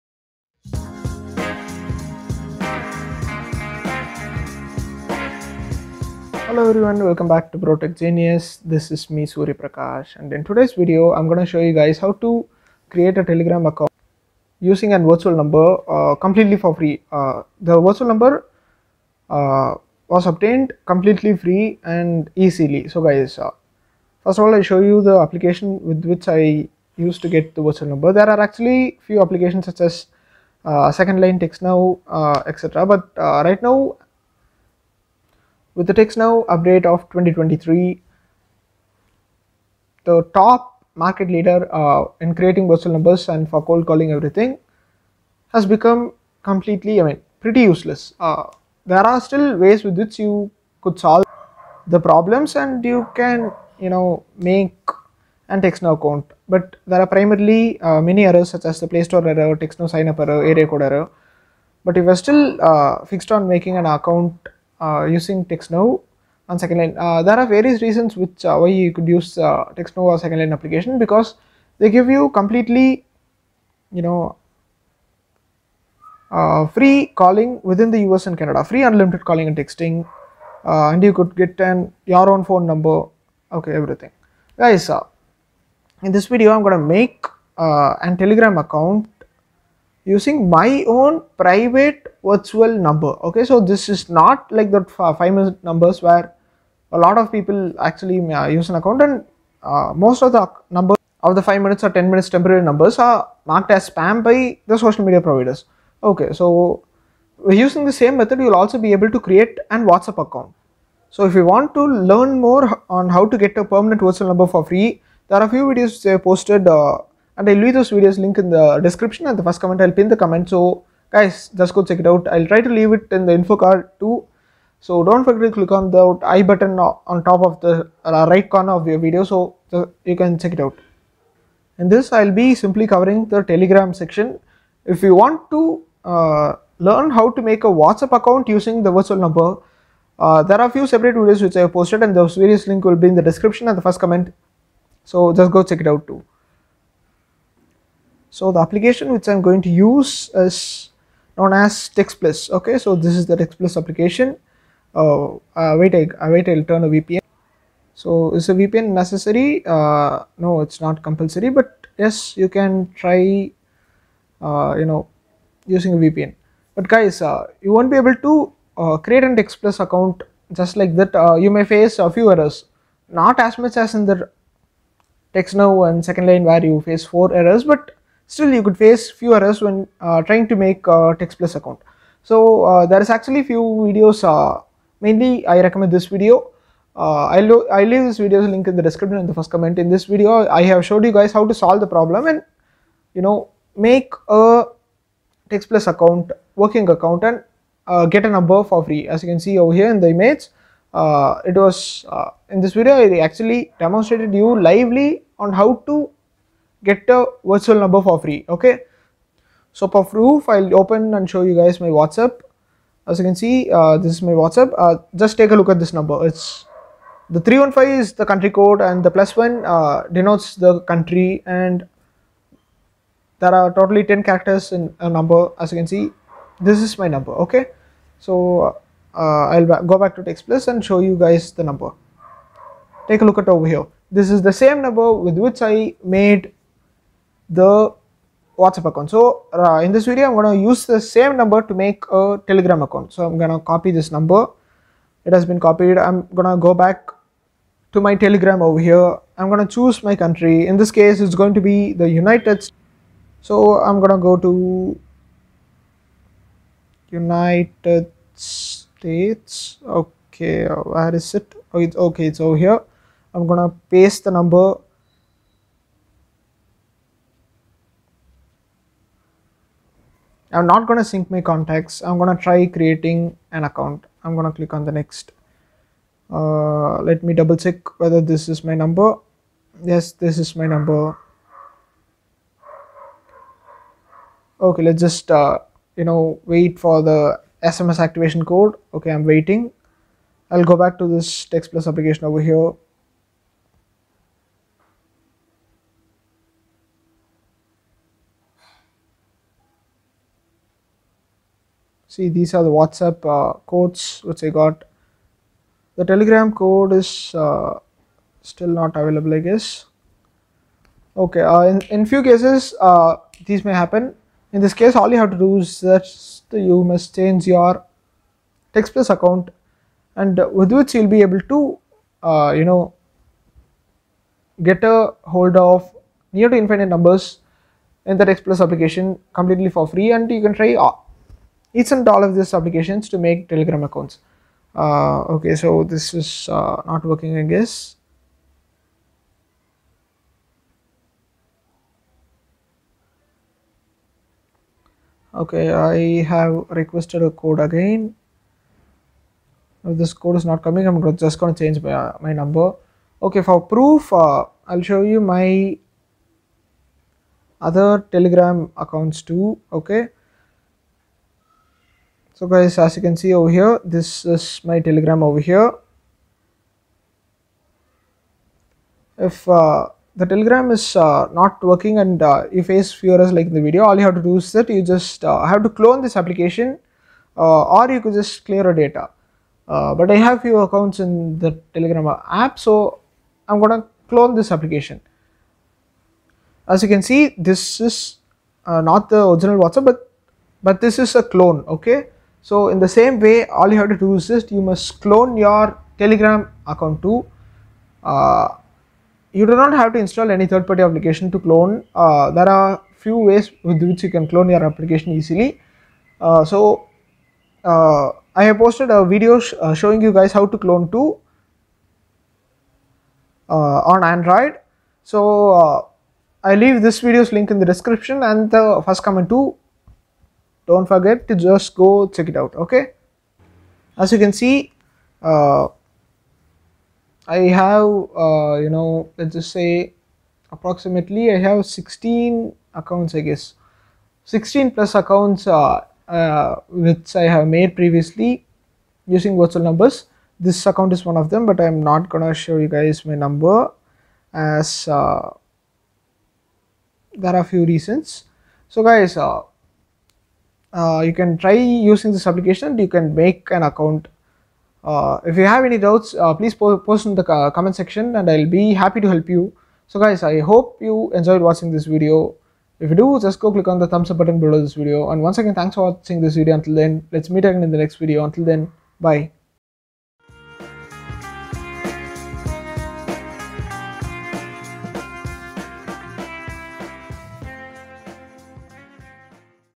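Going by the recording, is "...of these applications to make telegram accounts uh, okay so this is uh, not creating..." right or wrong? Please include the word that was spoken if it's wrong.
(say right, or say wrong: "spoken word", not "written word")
wrong: "working", not "creating".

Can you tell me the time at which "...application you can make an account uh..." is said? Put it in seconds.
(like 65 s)
452 s.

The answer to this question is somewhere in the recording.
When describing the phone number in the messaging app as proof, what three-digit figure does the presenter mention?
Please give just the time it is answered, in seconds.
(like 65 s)
217 s.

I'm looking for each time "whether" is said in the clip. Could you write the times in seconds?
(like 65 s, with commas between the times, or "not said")
277 s.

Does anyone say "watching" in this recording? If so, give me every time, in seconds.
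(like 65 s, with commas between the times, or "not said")
461 s, 465 s.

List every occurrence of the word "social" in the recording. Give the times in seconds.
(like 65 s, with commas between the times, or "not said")
104 s.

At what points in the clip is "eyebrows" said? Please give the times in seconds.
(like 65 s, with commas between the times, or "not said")
not said.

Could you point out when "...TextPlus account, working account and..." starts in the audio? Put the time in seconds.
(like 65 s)
195 s.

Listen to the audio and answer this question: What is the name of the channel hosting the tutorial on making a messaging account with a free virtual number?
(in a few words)
Protech Genius.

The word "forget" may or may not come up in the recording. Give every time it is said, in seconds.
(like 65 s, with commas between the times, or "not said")
125 s, 420 s.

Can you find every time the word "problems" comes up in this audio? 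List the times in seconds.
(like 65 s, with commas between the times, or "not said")
52 s, 191 s.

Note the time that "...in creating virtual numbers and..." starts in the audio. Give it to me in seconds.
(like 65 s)
42 s.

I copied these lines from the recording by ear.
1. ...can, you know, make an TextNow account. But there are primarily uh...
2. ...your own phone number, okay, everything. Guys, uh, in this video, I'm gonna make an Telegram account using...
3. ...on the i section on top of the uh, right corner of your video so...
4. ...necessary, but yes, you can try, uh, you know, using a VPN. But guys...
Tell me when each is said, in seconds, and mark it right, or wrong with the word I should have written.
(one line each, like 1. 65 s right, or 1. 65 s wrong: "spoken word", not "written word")
1. 53 s right
2. 82 s right
3. 125 s wrong: "button", not "section"
4. 161 s wrong: "compulsory", not "necessary".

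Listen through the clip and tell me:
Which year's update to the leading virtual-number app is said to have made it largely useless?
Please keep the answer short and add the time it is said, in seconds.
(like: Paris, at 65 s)
2023, at 37 s.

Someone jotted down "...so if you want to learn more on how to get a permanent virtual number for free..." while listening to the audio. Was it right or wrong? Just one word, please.
right.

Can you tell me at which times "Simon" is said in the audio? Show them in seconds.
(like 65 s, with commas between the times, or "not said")
not said.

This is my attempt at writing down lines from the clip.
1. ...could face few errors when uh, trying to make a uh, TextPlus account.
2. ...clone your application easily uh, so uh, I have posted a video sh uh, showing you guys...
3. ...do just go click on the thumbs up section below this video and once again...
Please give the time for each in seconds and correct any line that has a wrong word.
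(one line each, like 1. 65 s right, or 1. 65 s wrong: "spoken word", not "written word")
1. 178 s right
2. 404 s right
3. 462 s wrong: "button", not "section".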